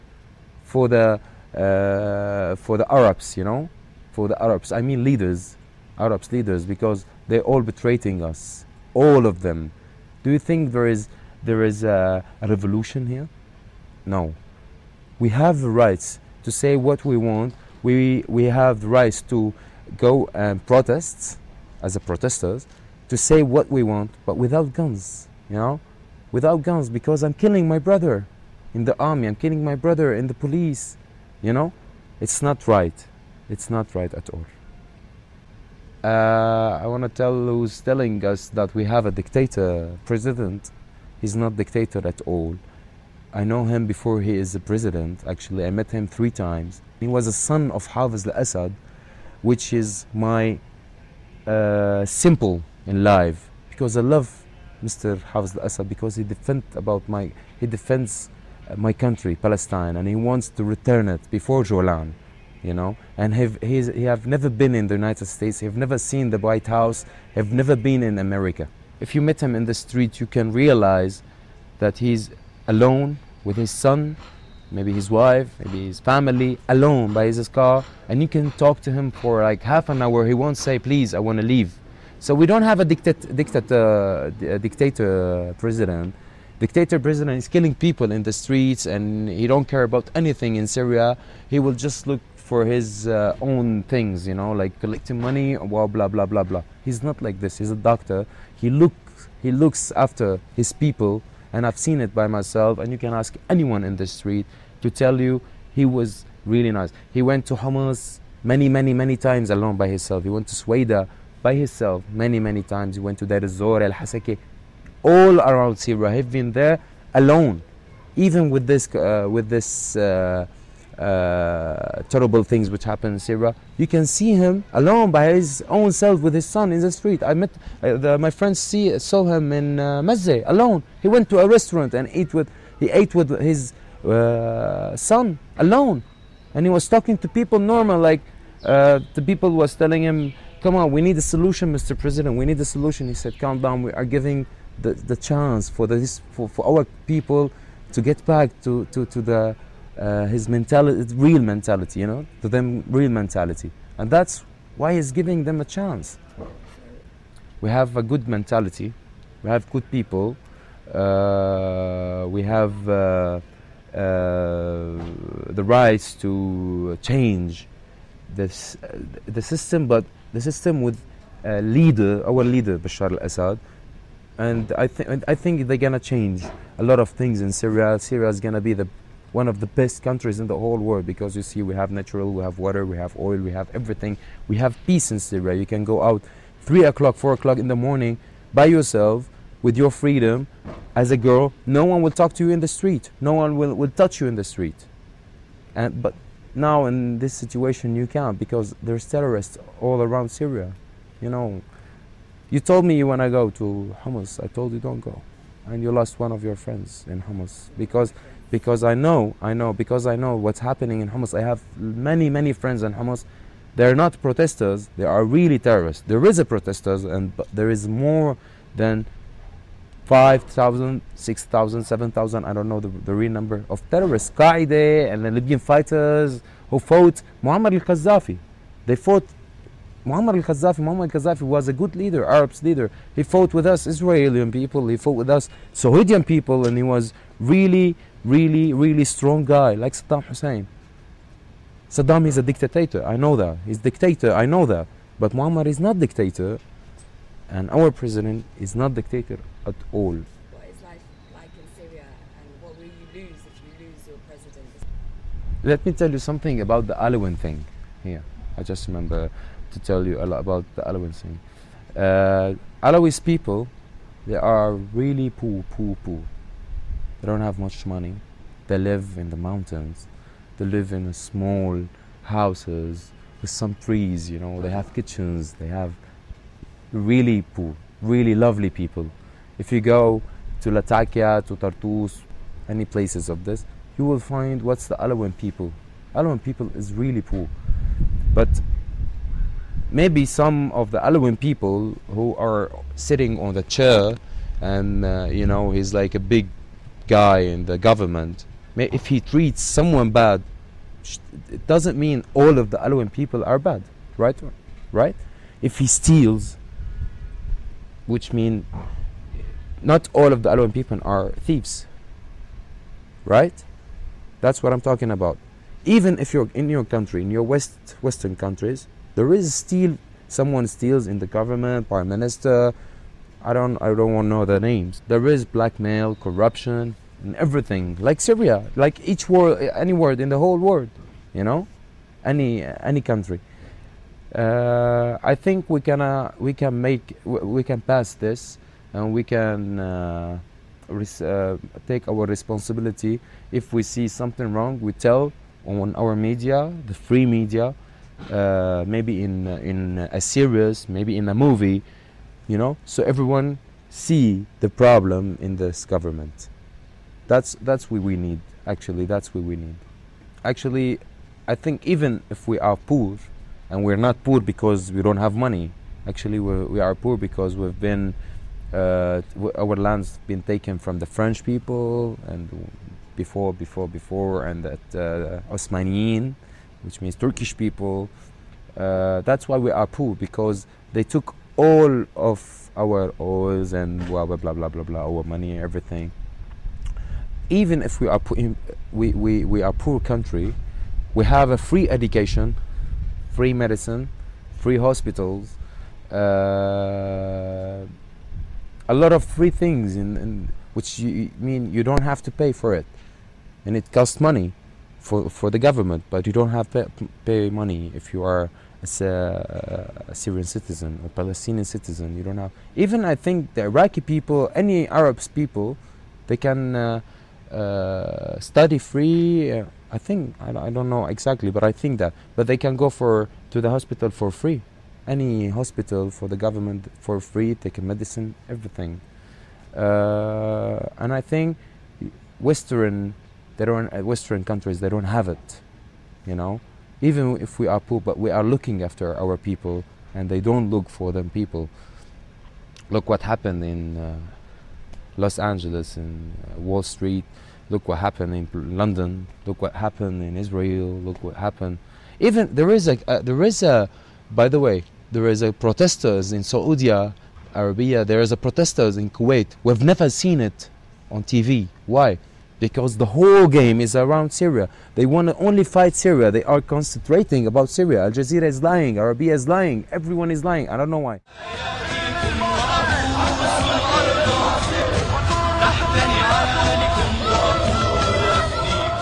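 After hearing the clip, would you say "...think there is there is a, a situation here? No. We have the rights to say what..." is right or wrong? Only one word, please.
wrong.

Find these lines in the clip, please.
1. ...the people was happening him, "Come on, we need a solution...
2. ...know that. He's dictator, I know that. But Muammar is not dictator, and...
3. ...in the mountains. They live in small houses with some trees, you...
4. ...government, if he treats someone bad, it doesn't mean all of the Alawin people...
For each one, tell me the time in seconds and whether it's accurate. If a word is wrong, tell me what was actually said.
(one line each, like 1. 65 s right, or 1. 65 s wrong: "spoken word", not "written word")
1. 139 s wrong: "telling", not "happening"
2. 243 s right
3. 269 s right
4. 297 s right.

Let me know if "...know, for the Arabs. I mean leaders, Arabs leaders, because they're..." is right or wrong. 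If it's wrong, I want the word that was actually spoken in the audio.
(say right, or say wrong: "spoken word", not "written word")
right.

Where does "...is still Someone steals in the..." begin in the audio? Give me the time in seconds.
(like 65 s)
319 s.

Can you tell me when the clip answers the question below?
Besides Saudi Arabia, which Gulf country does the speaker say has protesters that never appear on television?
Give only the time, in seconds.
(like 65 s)
459 s.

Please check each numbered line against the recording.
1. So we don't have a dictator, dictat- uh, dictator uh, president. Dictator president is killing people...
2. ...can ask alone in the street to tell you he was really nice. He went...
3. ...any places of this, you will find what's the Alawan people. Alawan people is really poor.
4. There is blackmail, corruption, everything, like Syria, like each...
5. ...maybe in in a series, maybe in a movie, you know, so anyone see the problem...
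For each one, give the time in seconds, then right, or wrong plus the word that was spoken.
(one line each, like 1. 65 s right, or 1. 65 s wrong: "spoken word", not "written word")
1. 82 s right
2. 102 s wrong: "anyone", not "alone"
3. 282 s right
4. 325 s right
5. 348 s wrong: "everyone", not "anyone".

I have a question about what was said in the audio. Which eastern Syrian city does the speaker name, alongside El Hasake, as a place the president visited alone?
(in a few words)
Deir Zor.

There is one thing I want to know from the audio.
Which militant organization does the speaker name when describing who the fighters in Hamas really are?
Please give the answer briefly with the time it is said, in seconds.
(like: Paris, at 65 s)
Qaeda, at 224 s.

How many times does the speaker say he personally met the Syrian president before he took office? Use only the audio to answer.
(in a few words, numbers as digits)
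3.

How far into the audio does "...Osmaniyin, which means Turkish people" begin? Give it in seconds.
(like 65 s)
375 s.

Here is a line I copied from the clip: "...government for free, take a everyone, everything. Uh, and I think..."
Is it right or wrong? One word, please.
wrong.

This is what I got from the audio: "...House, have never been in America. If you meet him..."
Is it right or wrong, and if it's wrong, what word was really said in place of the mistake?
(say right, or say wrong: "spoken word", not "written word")
right.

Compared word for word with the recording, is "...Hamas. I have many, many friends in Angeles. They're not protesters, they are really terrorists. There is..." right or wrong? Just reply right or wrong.
wrong.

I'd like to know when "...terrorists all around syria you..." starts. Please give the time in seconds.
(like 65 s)
199 s.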